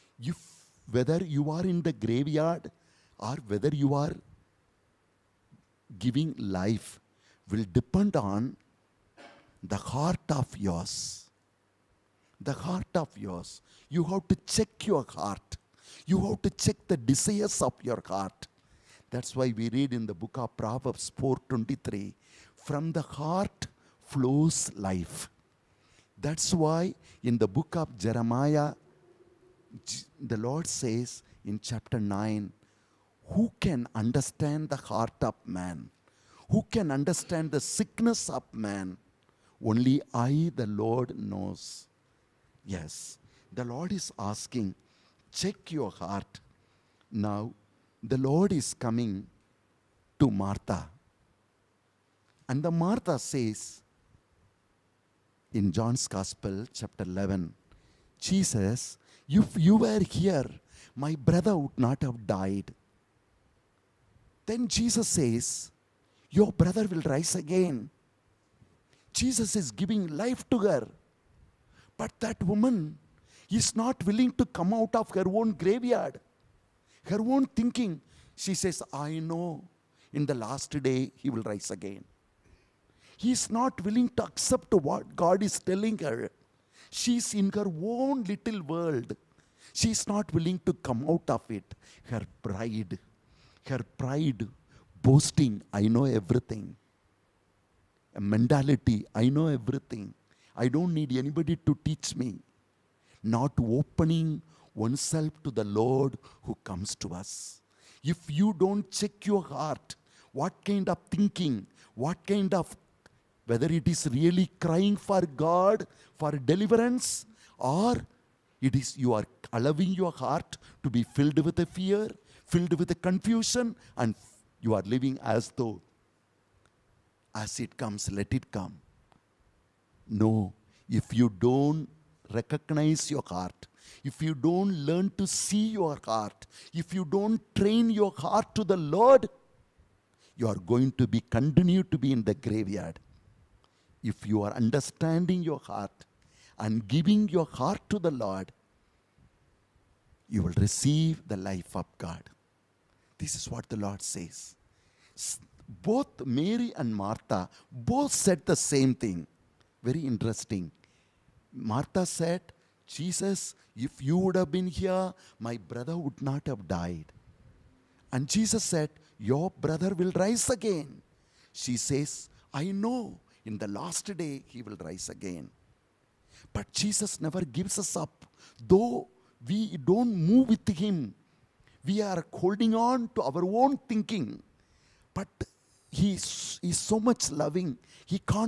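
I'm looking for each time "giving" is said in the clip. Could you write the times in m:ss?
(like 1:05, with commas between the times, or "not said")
0:05, 1:09, 2:26.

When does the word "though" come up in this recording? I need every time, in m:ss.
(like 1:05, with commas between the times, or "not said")
2:05, 2:58.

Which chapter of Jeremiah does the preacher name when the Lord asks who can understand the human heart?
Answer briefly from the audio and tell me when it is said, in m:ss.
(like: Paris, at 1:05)
Chapter 9, at 0:31.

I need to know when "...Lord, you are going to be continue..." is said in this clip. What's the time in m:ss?
2:18.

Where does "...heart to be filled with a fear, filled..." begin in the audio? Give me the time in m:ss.
2:00.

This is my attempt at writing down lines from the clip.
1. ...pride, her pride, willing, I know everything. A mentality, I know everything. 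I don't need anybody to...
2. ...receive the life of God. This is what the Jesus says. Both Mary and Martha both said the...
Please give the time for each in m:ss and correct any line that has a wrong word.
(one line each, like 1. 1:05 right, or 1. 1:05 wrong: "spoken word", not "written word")
1. 1:32 wrong: "boasting", not "willing"
2. 2:30 wrong: "Lord", not "Jesus".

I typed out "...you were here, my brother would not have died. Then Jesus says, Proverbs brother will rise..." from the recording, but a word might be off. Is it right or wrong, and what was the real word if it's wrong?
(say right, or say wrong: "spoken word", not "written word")
wrong: "Your", not "Proverbs".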